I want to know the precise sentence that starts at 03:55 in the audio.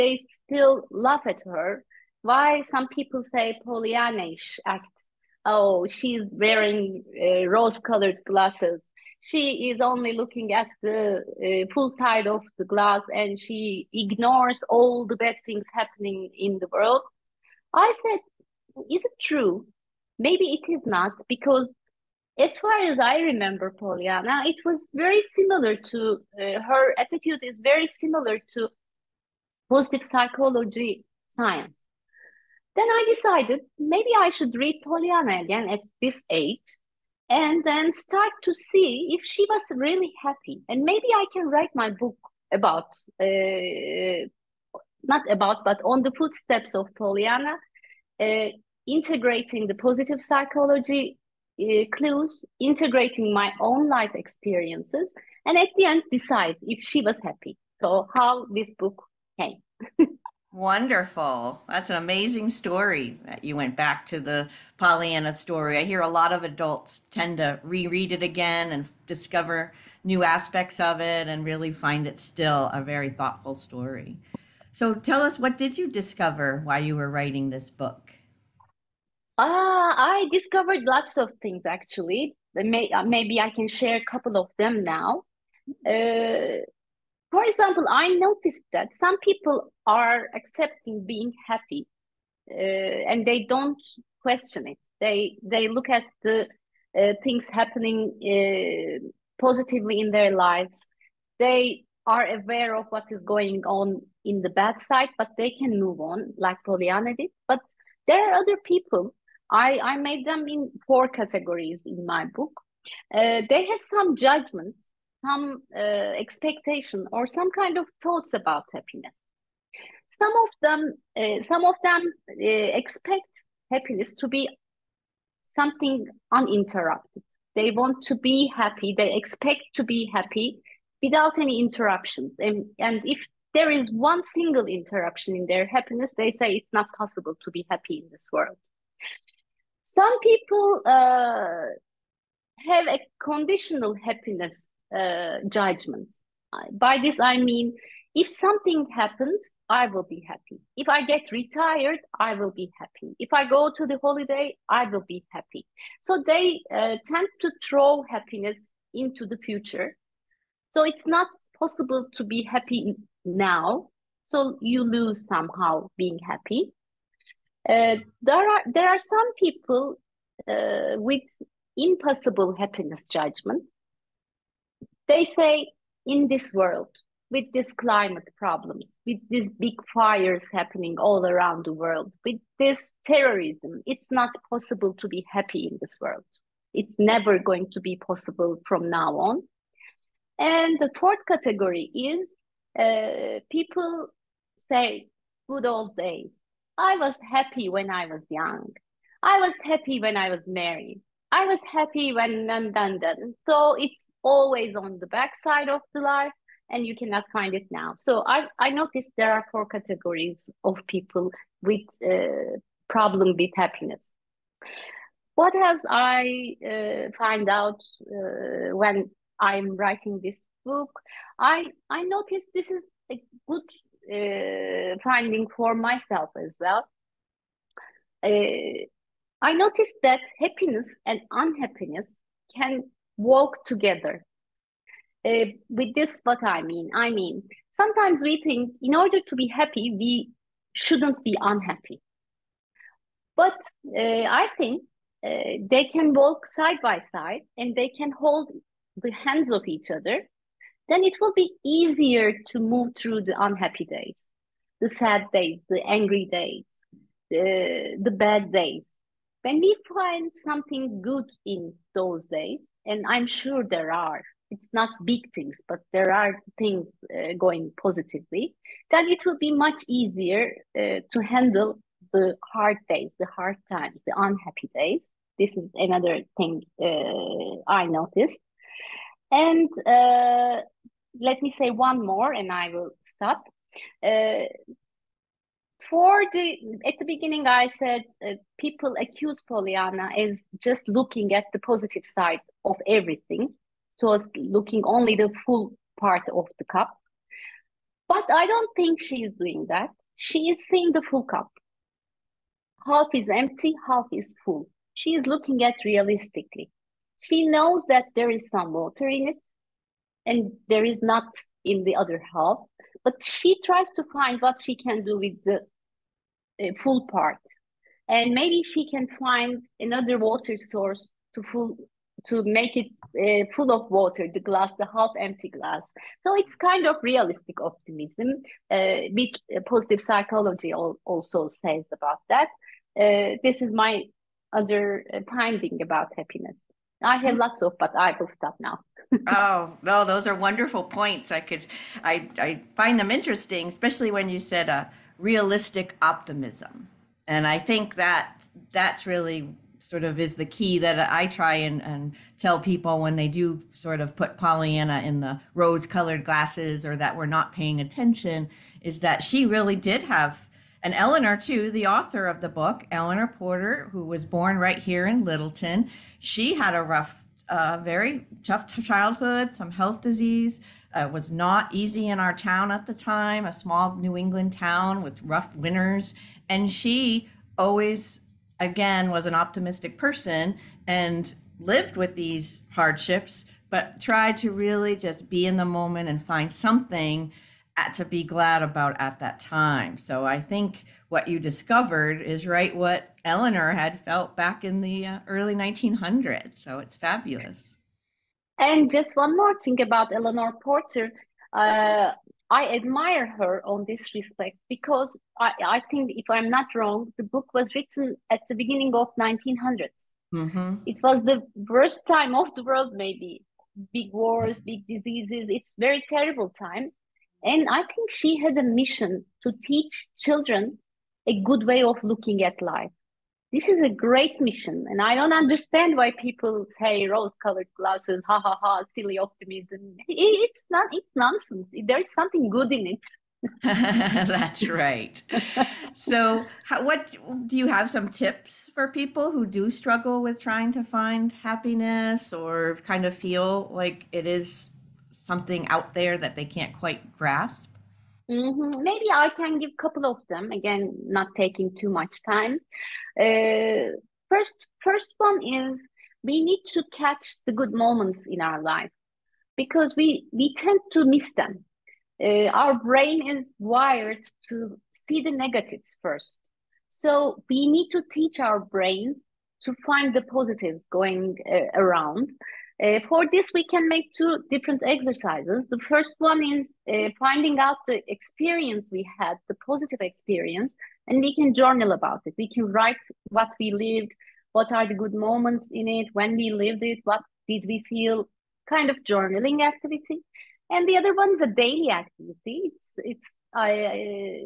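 Uh, with this, what I mean, I mean, sometimes we think in order to be happy, we shouldn't be unhappy.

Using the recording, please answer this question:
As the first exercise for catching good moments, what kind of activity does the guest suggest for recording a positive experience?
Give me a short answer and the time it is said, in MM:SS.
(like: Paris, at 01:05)
journaling, at 08:09.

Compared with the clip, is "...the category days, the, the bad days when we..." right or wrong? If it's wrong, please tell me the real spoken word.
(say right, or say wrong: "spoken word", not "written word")
wrong: "angry", not "category".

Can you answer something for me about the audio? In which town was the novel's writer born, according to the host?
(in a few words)
Littleton.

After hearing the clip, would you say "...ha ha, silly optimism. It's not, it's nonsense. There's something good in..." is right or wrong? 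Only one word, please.
right.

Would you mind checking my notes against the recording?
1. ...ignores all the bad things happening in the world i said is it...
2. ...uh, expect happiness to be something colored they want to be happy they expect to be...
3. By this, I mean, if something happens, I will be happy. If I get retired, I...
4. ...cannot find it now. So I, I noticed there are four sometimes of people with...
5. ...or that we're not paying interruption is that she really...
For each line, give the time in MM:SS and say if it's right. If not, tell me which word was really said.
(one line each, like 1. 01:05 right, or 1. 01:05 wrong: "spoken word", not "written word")
1. 00:13 right
2. 02:02 wrong: "uninterrupted", not "colored"
3. 02:26 right
4. 03:26 wrong: "categories", not "sometimes"
5. 05:56 wrong: "attention", not "interruption".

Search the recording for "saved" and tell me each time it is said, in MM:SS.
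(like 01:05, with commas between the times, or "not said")
not said.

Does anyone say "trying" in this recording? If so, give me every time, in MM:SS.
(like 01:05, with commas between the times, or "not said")
07:20.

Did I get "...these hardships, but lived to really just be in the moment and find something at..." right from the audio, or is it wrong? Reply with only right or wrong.
wrong.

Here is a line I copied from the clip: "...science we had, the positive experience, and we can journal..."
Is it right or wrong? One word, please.
wrong.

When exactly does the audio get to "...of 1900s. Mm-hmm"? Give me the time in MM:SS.
06:48.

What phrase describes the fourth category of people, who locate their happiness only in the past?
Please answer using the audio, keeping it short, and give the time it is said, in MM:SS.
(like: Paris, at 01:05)
good old days, at 03:15.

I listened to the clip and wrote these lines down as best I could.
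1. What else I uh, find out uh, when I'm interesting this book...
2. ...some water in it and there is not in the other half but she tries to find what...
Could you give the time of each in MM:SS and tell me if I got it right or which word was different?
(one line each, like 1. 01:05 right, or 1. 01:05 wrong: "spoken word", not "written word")
1. 03:35 wrong: "writing", not "interesting"
2. 05:08 right.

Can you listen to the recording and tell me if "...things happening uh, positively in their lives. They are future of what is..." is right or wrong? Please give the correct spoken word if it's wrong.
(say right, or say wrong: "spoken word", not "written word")
wrong: "aware", not "future".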